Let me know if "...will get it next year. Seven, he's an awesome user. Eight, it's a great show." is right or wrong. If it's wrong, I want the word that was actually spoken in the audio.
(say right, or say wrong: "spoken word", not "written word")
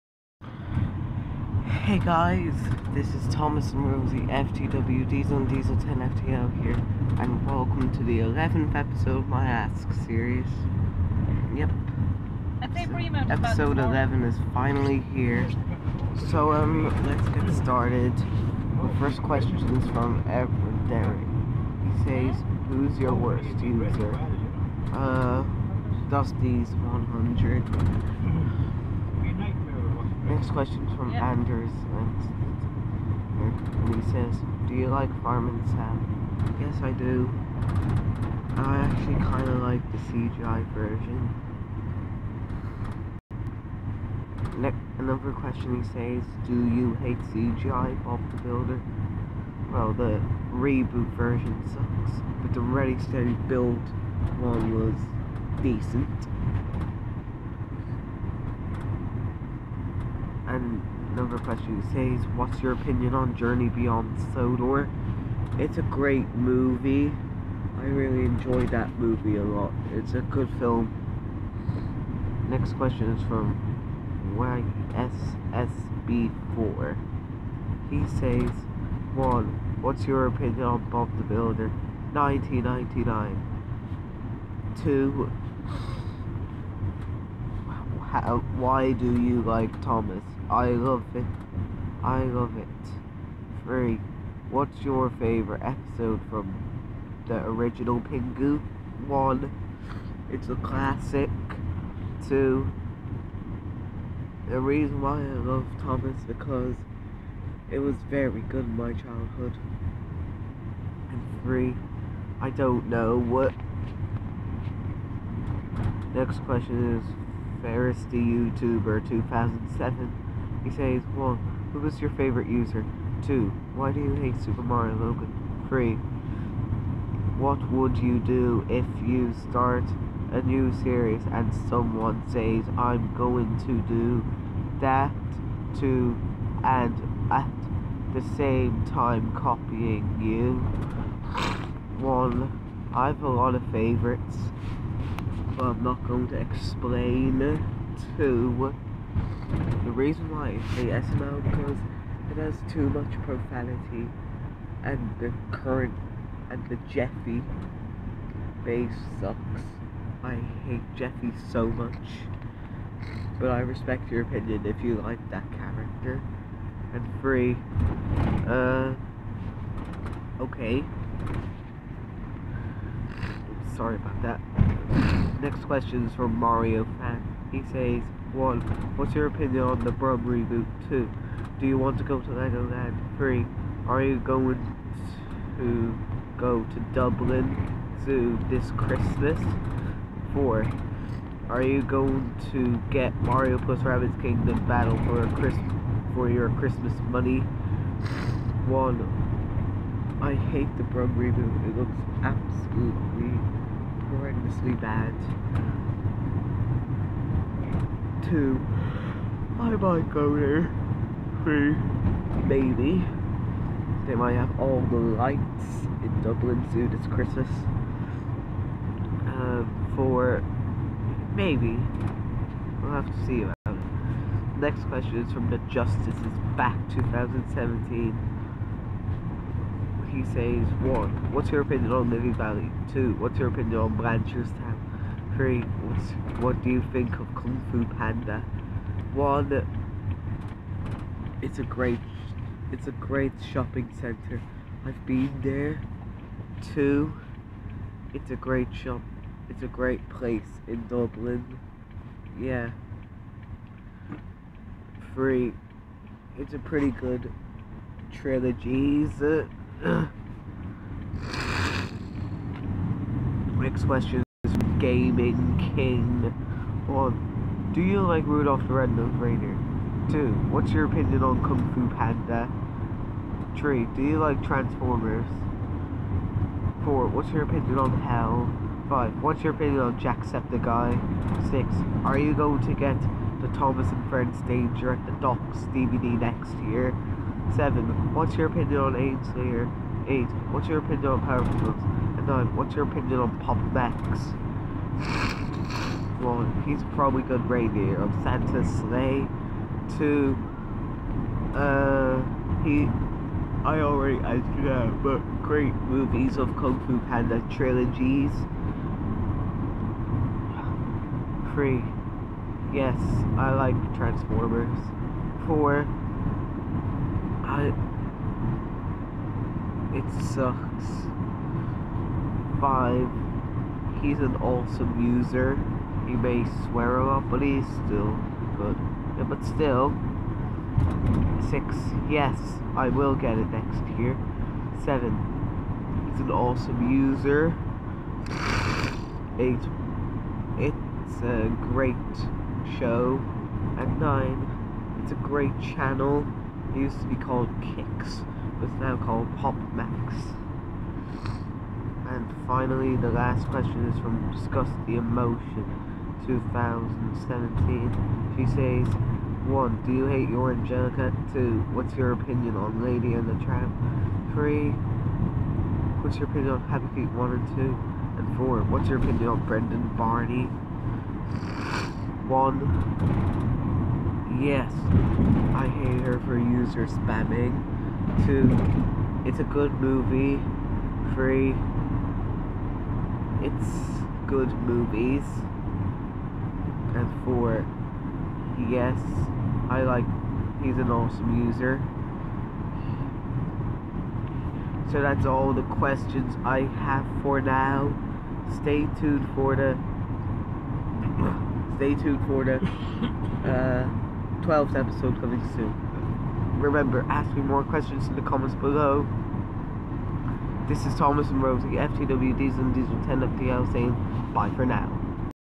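right.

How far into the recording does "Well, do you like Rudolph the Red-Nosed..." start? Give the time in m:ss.
4:26.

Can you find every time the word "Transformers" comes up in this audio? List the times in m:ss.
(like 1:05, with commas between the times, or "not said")
4:34, 5:13.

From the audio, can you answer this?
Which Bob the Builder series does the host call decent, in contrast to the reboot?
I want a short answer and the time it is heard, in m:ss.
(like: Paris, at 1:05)
Ready Steady Build, at 0:52.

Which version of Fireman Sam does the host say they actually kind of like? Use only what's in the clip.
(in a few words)
The CGI version.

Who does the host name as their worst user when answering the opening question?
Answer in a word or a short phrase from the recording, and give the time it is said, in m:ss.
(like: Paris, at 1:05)
Dusty's 100, at 0:26.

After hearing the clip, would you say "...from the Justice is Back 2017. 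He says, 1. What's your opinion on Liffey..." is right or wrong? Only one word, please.
right.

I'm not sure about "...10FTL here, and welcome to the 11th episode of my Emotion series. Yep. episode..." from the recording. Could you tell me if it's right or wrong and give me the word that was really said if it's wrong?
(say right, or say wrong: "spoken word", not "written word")
wrong: "Ask", not "Emotion".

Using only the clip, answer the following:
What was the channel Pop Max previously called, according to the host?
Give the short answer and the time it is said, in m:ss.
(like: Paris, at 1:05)
Kix, at 5:47.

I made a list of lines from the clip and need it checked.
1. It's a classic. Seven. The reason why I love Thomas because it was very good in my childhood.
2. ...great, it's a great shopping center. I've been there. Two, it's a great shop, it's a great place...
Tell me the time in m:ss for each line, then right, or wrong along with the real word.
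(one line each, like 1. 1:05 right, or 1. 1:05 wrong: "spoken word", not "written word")
1. 1:40 wrong: "Two", not "Seven"
2. 4:01 right.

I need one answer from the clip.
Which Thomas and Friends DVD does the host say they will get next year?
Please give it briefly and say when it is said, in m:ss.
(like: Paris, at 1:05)
Danger at the Docks, at 4:44.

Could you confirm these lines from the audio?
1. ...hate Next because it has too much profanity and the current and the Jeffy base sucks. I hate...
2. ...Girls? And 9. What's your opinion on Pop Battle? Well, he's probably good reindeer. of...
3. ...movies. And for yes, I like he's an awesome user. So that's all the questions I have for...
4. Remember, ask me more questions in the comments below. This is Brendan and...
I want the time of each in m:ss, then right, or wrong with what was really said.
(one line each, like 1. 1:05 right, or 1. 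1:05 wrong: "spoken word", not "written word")
1. 2:30 wrong: "SML", not "Next"
2. 4:51 wrong: "Max", not "Battle"
3. 6:24 right
4. 6:46 wrong: "Thomas", not "Brendan".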